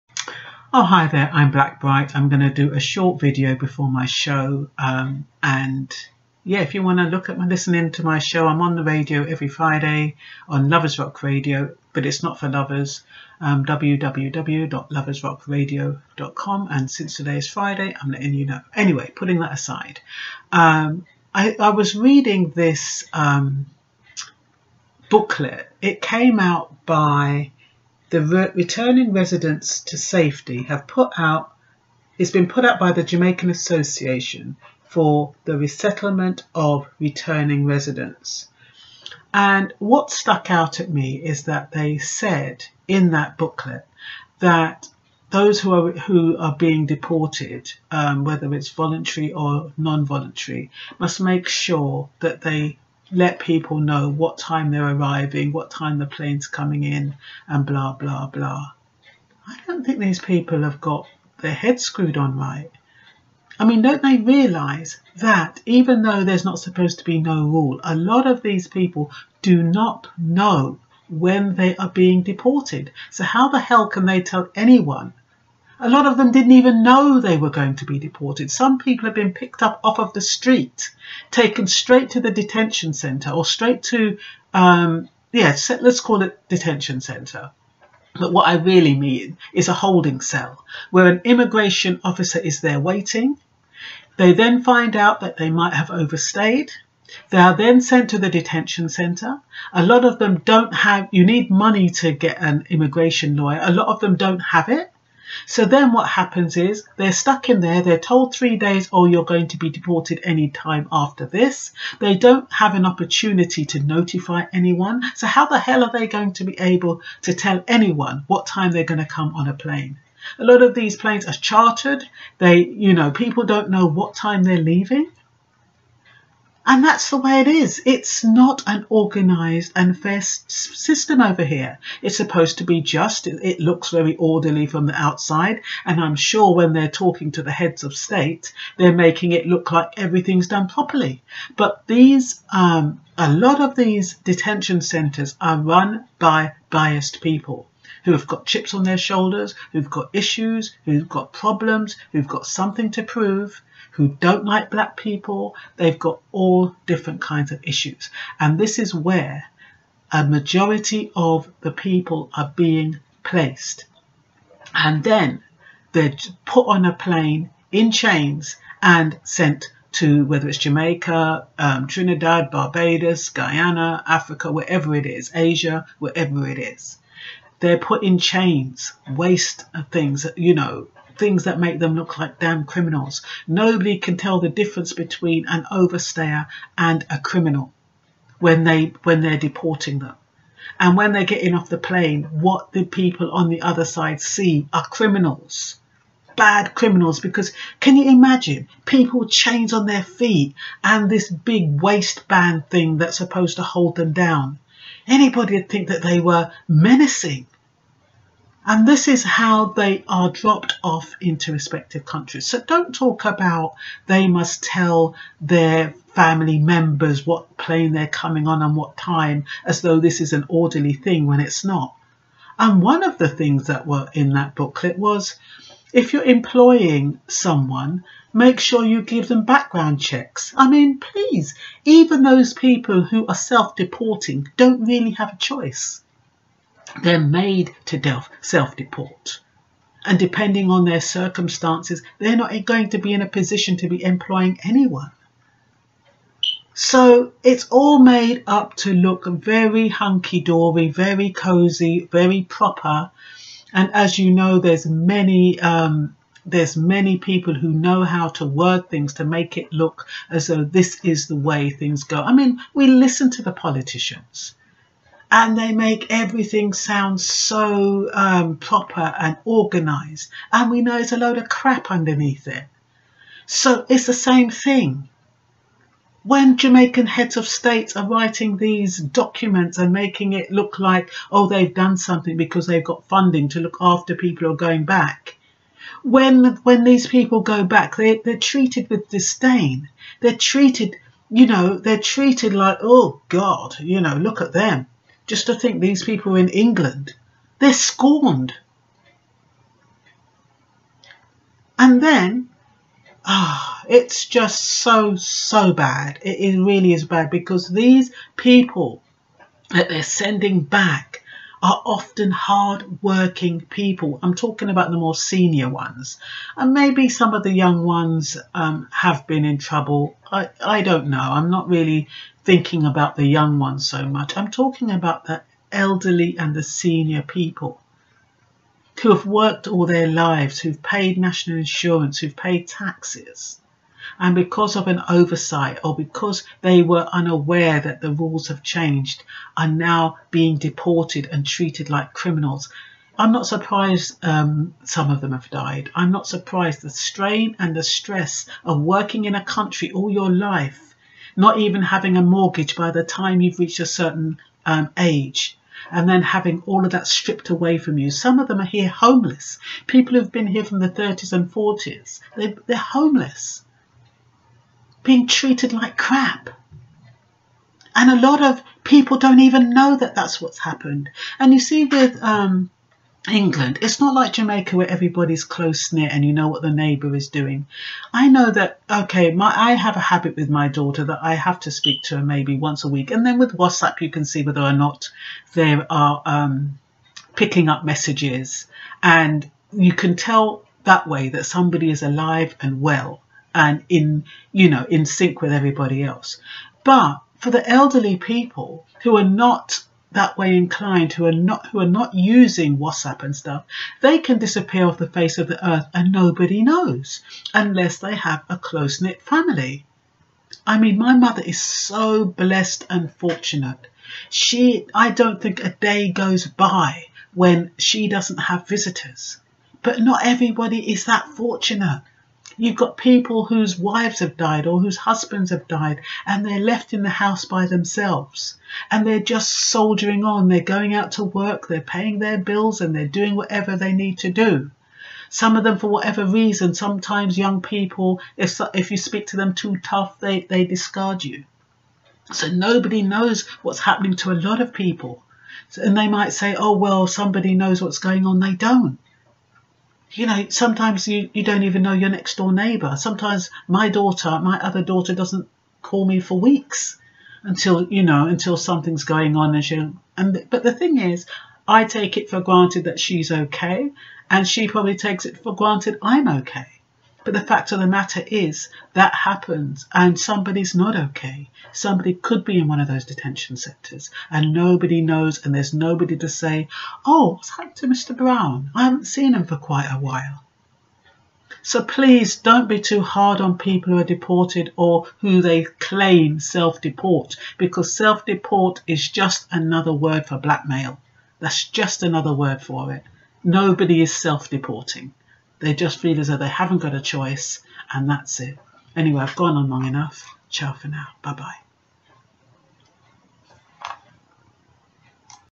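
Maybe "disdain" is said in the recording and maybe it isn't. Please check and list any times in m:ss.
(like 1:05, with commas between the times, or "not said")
4:49.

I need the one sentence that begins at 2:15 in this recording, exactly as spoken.
And I'm sure when they're talking to the heads of state, they're making it look like everything's done properly.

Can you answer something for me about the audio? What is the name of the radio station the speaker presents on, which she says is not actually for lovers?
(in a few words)
Lovers Rock Radio.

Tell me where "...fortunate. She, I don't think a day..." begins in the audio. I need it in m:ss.
6:53.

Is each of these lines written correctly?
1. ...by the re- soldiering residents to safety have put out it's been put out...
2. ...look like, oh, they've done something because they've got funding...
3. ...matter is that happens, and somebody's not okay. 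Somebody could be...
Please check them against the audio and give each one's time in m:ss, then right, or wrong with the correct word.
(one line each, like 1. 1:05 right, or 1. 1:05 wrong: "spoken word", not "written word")
1. 0:26 wrong: "returning", not "soldiering"
2. 4:40 right
3. 7:47 right.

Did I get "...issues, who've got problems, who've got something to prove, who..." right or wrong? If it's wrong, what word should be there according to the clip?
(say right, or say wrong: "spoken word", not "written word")
right.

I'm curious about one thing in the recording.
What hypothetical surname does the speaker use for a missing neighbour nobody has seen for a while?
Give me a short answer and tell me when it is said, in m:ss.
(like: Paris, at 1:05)
Mr. Brown, at 7:57.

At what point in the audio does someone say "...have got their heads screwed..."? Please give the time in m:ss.
1:00.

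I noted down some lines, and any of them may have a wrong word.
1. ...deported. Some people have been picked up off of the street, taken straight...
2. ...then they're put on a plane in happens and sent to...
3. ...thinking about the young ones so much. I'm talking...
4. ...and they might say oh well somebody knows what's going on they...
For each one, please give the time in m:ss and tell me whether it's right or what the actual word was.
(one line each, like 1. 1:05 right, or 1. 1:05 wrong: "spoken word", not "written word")
1. 1:17 right
2. 2:45 wrong: "chains", not "happens"
3. 5:22 right
4. 7:25 right.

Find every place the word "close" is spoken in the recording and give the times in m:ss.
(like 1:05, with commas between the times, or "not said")
6:15, 6:48.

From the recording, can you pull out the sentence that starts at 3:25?
Anybody would think that they were menacing and this is how they are dropped off into respective countries.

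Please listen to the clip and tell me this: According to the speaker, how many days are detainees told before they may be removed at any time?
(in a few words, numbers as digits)
3 days.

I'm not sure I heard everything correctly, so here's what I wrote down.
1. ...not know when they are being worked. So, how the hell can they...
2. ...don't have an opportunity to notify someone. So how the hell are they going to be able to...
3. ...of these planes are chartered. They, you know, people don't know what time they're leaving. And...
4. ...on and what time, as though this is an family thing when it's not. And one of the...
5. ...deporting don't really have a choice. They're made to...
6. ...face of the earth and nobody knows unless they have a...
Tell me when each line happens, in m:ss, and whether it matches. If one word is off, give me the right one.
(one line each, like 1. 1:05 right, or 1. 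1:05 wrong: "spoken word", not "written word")
1. 1:09 wrong: "deported", not "worked"
2. 1:52 wrong: "anyone", not "someone"
3. 2:00 right
4. 3:38 wrong: "orderly", not "family"
5. 3:53 right
6. 6:45 right.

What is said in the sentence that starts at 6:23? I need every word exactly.
And then with WhatsApp, you can see whether or not there are um, picking up messages.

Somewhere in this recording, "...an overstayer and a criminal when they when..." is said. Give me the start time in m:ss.
3:05.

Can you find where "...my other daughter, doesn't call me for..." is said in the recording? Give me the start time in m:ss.
7:34.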